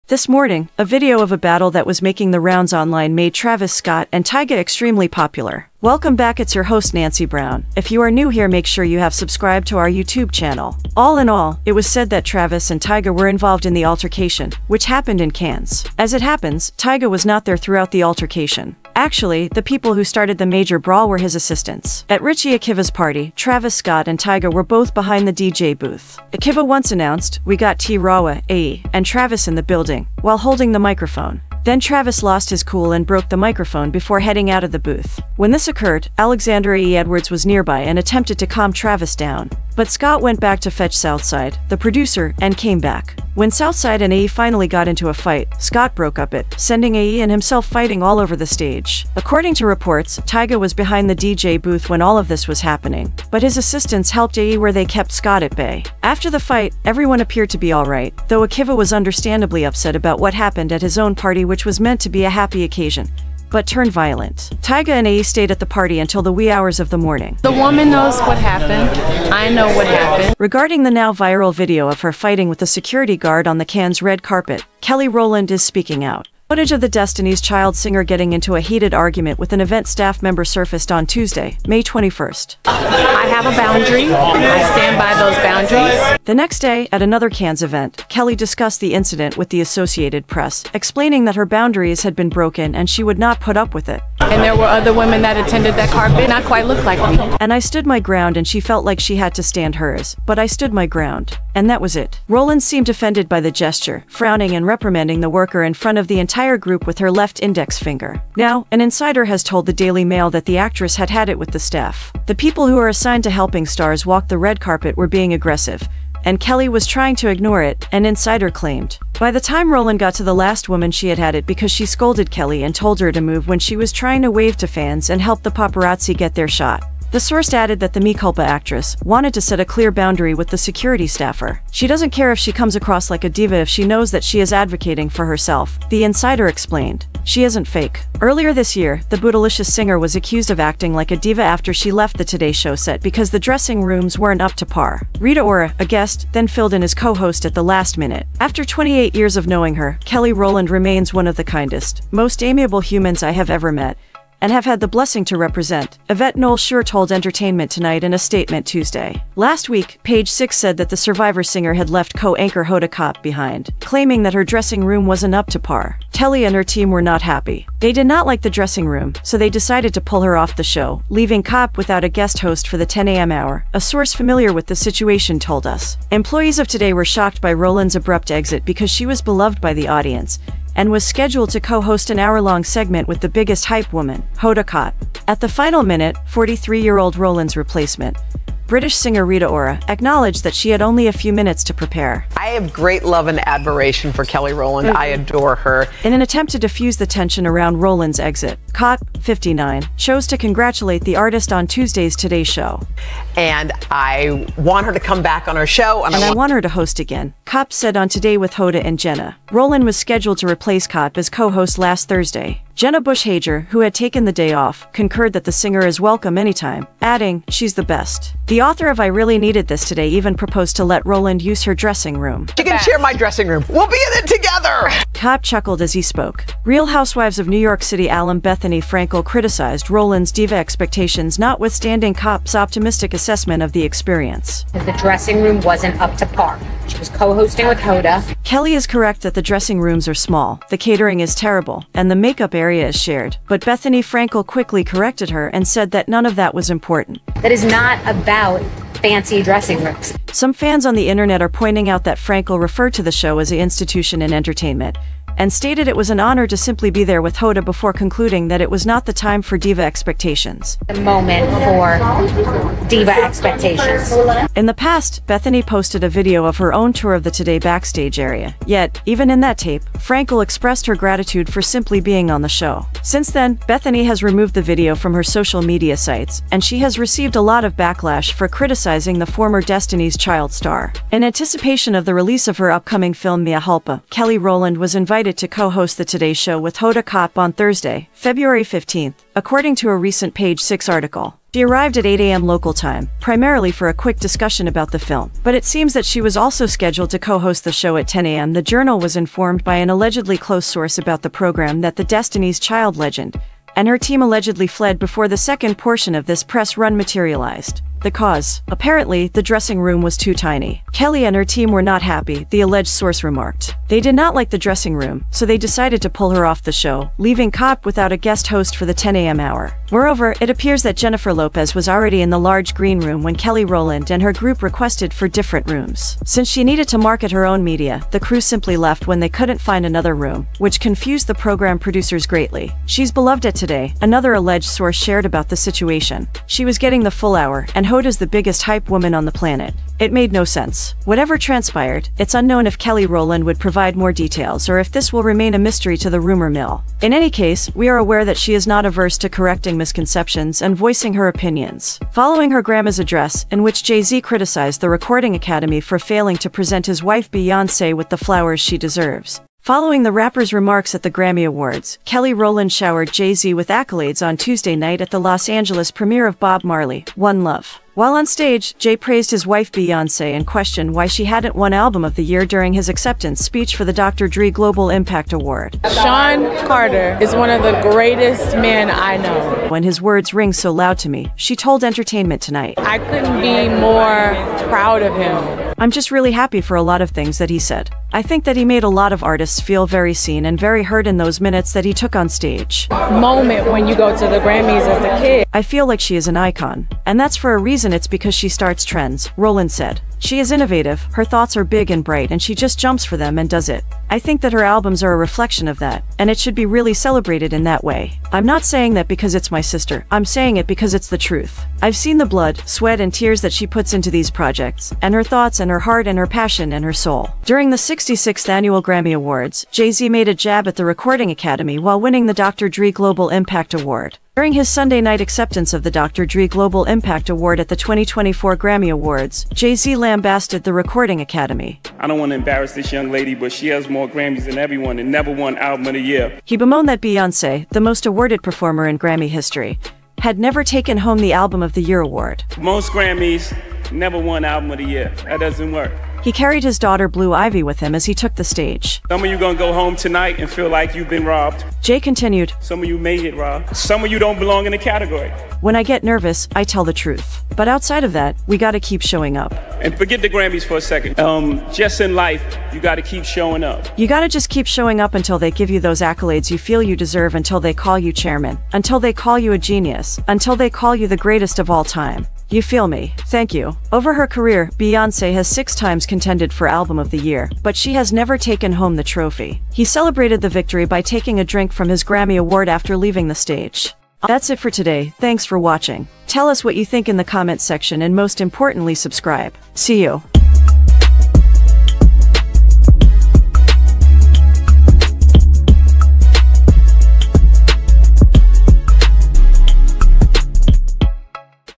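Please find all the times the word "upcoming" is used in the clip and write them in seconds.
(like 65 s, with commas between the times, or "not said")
282 s.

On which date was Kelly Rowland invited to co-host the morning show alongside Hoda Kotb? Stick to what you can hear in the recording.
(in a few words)
February 15th.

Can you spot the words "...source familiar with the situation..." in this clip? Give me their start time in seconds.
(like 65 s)
173 s.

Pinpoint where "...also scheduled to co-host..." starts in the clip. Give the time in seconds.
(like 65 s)
296 s.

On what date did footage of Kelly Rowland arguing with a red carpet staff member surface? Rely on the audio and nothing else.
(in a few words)
May 21st.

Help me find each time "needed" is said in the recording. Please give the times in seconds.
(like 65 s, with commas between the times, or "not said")
219 s, 326 s.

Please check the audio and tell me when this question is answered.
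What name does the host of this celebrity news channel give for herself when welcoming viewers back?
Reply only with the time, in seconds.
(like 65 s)
6 s.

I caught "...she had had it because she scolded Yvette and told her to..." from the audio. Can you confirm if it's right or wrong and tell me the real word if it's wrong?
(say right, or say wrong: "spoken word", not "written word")
wrong: "Kelly", not "Yvette".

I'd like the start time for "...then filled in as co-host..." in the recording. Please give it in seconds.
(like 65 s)
146 s.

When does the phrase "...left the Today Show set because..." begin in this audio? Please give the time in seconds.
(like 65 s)
141 s.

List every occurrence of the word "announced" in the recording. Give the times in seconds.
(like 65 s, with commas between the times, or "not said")
26 s.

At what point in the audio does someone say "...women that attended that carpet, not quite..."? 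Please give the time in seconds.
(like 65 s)
94 s.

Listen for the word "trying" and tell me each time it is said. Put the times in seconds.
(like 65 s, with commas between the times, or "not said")
116 s, 123 s.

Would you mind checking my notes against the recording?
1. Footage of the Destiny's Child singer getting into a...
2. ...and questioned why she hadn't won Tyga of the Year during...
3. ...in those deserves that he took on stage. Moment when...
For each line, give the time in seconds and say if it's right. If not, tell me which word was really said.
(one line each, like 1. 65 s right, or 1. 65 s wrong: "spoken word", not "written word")
1. 76 s right
2. 370 s wrong: "Album", not "Tyga"
3. 391 s wrong: "minutes", not "deserves".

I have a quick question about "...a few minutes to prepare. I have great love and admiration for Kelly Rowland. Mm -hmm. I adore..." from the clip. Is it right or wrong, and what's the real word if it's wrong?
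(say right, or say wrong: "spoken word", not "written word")
right.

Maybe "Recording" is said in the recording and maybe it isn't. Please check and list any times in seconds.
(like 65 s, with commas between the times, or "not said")
354 s, 420 s, 430 s.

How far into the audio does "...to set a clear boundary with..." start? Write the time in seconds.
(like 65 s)
129 s.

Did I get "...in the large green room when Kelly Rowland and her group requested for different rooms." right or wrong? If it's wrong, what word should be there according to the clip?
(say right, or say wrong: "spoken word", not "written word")
right.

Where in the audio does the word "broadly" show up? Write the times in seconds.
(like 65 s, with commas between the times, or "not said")
not said.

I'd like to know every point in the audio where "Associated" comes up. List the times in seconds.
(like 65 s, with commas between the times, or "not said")
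89 s.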